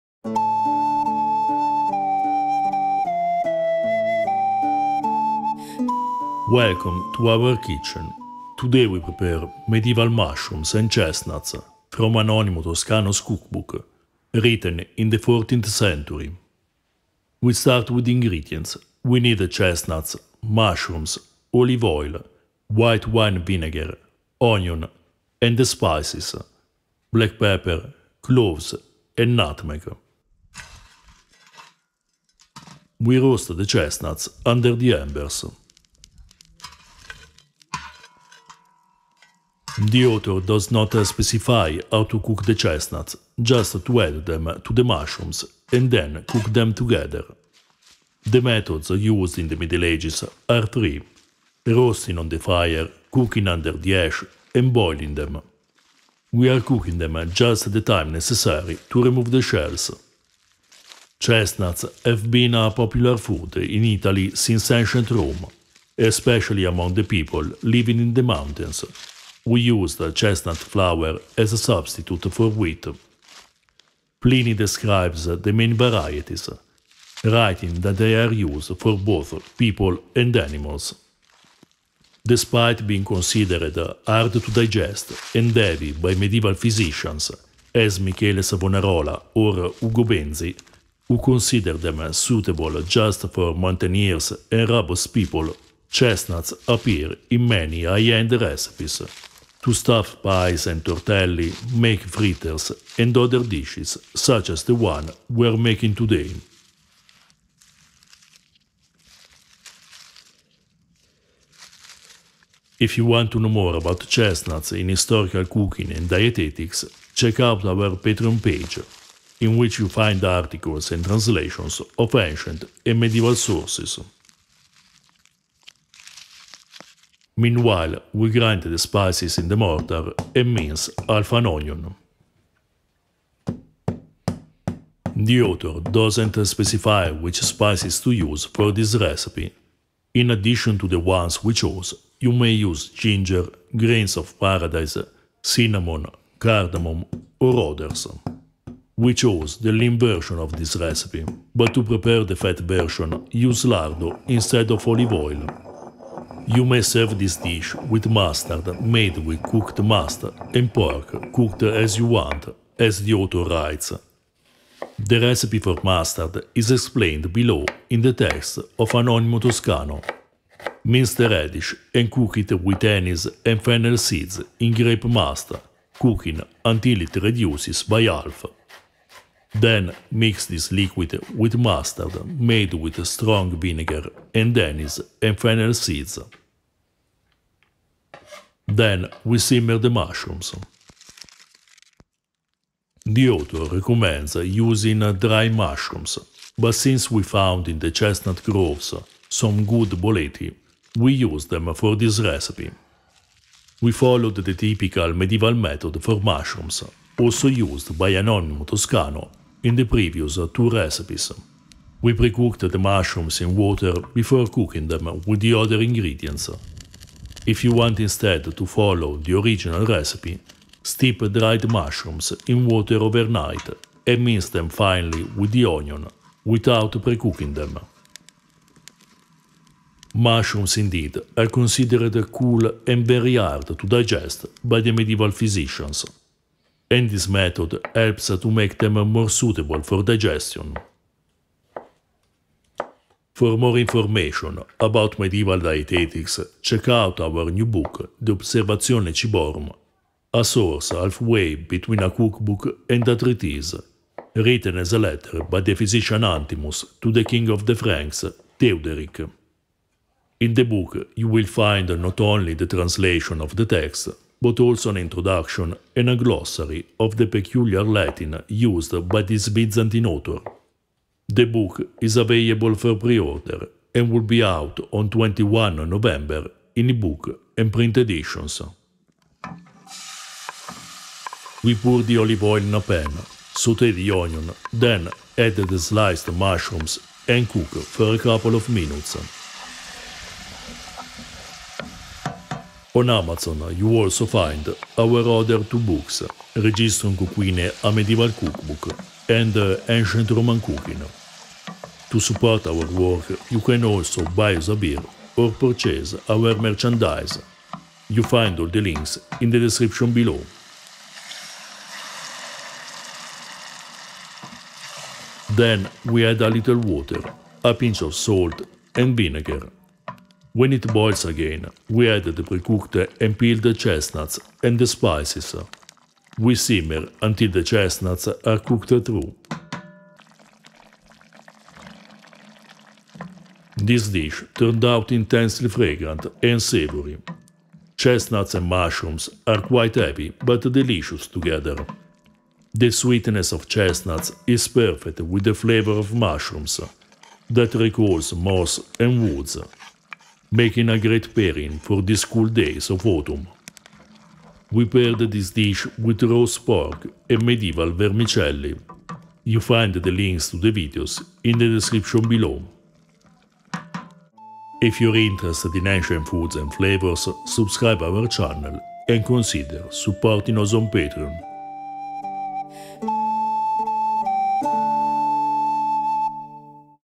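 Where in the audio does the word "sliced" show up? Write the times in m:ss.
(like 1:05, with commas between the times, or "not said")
4:45.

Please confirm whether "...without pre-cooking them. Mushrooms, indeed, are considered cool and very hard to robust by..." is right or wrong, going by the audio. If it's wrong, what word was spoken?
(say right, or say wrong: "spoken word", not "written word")
wrong: "digest", not "robust".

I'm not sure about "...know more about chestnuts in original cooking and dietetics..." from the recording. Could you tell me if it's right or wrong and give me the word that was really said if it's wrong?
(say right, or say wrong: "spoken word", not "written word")
wrong: "historical", not "original".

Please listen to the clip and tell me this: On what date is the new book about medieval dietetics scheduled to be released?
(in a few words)
21 November.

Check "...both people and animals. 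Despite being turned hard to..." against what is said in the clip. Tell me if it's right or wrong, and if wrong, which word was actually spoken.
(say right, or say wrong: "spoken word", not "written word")
wrong: "considered", not "turned".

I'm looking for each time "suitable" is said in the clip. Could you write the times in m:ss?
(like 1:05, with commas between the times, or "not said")
1:32, 3:59.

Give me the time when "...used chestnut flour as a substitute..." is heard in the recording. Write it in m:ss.
1:09.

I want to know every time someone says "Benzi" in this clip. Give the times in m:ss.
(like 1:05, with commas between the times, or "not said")
1:30.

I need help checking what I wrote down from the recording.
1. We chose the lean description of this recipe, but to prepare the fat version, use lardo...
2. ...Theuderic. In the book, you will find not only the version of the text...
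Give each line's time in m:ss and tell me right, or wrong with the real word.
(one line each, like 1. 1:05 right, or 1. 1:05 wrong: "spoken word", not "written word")
1. 2:28 wrong: "version", not "description"
2. 4:18 wrong: "translation", not "version".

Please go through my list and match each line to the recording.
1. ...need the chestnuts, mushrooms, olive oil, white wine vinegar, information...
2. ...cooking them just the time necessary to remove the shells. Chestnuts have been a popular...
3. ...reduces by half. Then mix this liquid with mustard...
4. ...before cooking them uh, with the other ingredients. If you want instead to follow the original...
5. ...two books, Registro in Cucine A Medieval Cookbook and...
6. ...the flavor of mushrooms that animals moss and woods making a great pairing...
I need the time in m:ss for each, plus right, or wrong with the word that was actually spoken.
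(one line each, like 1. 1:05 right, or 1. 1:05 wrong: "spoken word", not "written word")
1. 0:19 wrong: "onion", not "information"
2. 0:56 right
3. 2:57 right
4. 3:34 right
5. 4:55 right
6. 5:45 wrong: "recalls", not "animals".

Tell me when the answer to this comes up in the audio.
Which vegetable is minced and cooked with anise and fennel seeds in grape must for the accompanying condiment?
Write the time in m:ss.
2:51.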